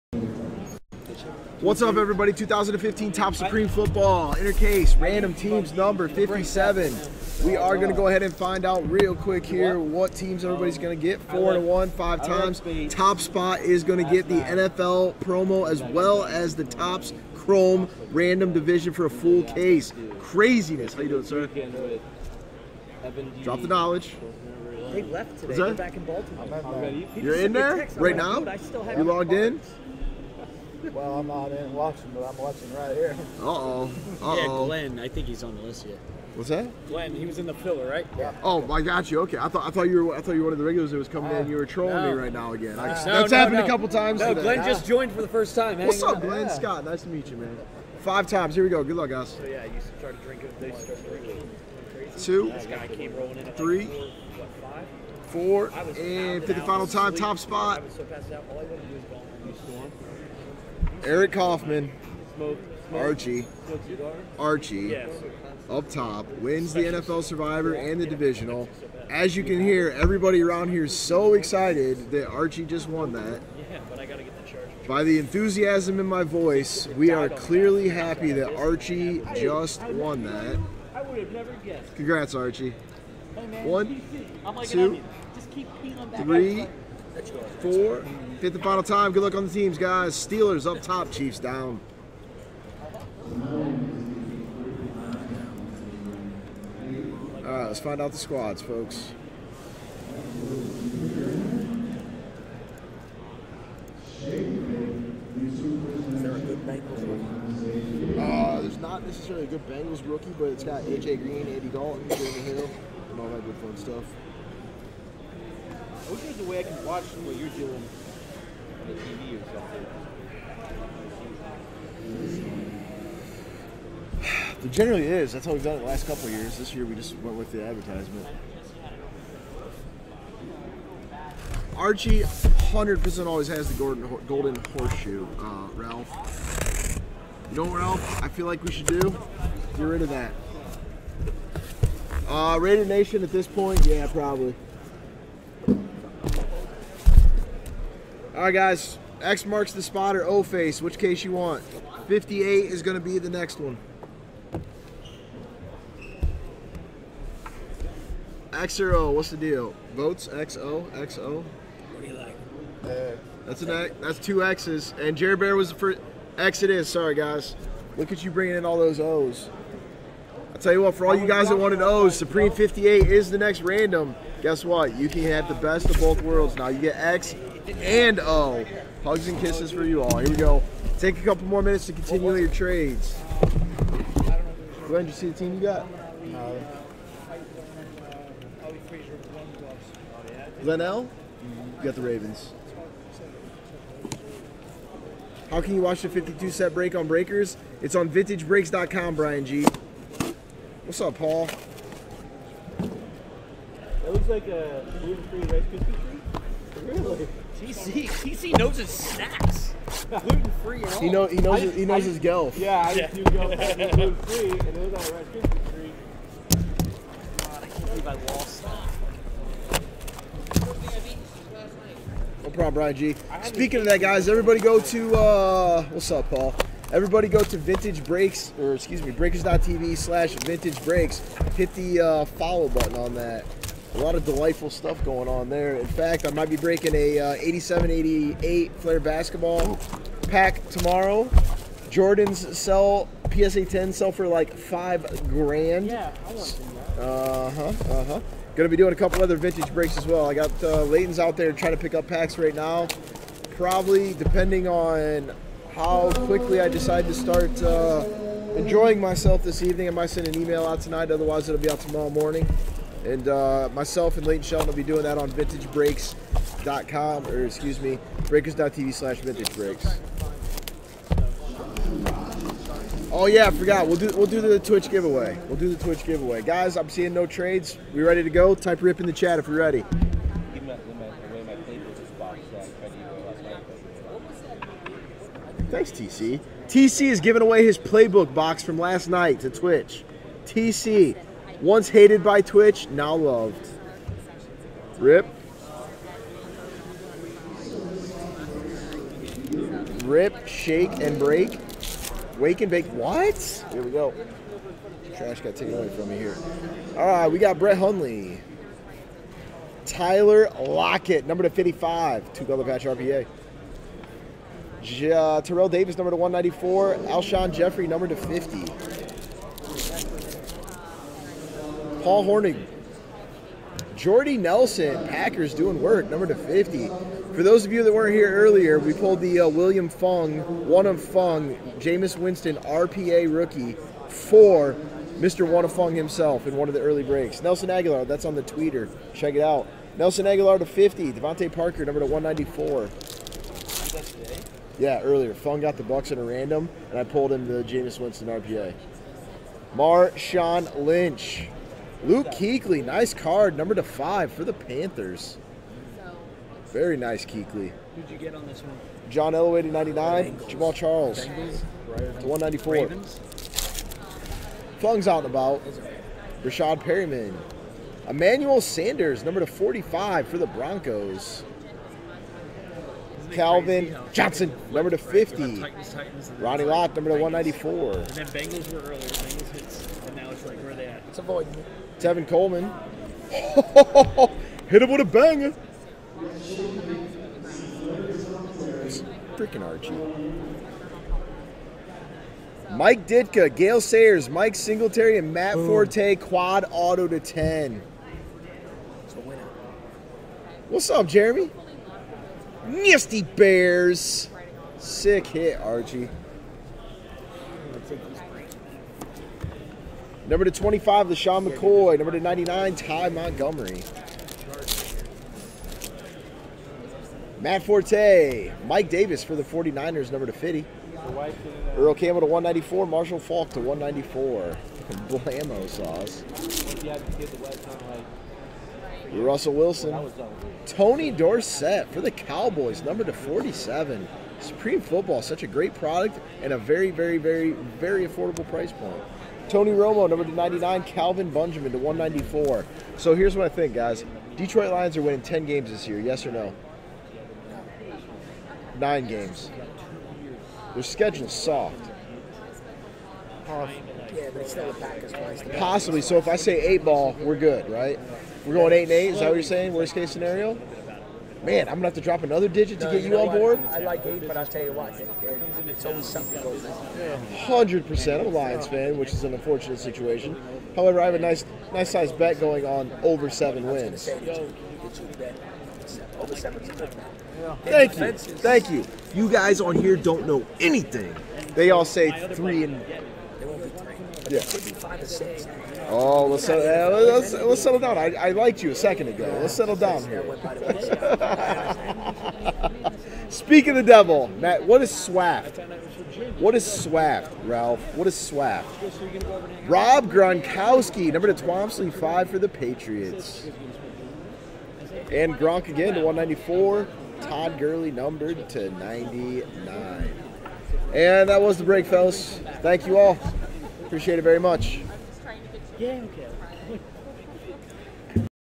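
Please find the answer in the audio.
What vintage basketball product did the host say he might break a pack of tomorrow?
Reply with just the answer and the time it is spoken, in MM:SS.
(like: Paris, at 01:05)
87 88 Fleer, at 03:57.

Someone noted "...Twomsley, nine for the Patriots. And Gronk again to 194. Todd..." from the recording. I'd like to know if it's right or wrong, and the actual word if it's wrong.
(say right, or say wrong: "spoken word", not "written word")
wrong: "five", not "nine".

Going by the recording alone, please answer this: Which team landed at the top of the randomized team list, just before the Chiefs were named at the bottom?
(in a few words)
Steelers.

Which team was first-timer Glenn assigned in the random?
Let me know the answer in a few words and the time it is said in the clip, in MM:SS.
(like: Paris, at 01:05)
Ravens, at 03:12.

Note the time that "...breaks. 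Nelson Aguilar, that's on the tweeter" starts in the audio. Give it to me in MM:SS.
05:37.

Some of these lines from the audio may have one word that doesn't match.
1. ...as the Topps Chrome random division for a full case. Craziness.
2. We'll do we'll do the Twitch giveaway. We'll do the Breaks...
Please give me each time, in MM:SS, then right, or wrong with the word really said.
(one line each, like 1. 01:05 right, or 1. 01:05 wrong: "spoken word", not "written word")
1. 00:16 right
2. 04:33 wrong: "Twitch", not "Breaks".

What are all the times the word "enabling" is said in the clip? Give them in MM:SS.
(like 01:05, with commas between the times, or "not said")
not said.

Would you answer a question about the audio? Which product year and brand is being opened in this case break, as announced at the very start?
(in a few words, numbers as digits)
2015 Topps Supreme Football.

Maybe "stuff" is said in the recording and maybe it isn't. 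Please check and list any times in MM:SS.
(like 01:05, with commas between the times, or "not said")
01:53, 03:54.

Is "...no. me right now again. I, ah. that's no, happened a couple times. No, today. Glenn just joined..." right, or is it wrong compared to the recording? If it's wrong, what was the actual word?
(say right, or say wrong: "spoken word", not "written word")
right.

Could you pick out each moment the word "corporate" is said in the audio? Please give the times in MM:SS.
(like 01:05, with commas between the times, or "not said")
not said.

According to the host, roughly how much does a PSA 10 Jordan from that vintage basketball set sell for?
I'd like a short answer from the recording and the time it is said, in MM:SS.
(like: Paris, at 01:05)
5 grand, at 04:04.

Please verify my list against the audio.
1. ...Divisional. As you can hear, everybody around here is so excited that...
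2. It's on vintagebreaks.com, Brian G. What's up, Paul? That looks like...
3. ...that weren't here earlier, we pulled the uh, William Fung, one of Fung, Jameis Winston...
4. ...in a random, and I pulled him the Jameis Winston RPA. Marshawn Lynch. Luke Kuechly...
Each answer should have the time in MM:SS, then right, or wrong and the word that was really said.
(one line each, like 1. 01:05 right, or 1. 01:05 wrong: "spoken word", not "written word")
1. 01:08 right
2. 03:17 right
3. 05:27 right
4. 05:46 right.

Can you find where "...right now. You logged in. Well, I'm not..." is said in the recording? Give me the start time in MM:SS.
00:27.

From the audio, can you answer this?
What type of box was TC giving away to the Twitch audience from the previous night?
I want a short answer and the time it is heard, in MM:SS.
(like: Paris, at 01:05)
playbook box, at 04:47.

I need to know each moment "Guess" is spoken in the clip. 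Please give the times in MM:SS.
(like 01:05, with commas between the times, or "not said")
02:54.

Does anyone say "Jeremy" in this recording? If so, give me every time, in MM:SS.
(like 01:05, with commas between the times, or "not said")
01:52, 06:41.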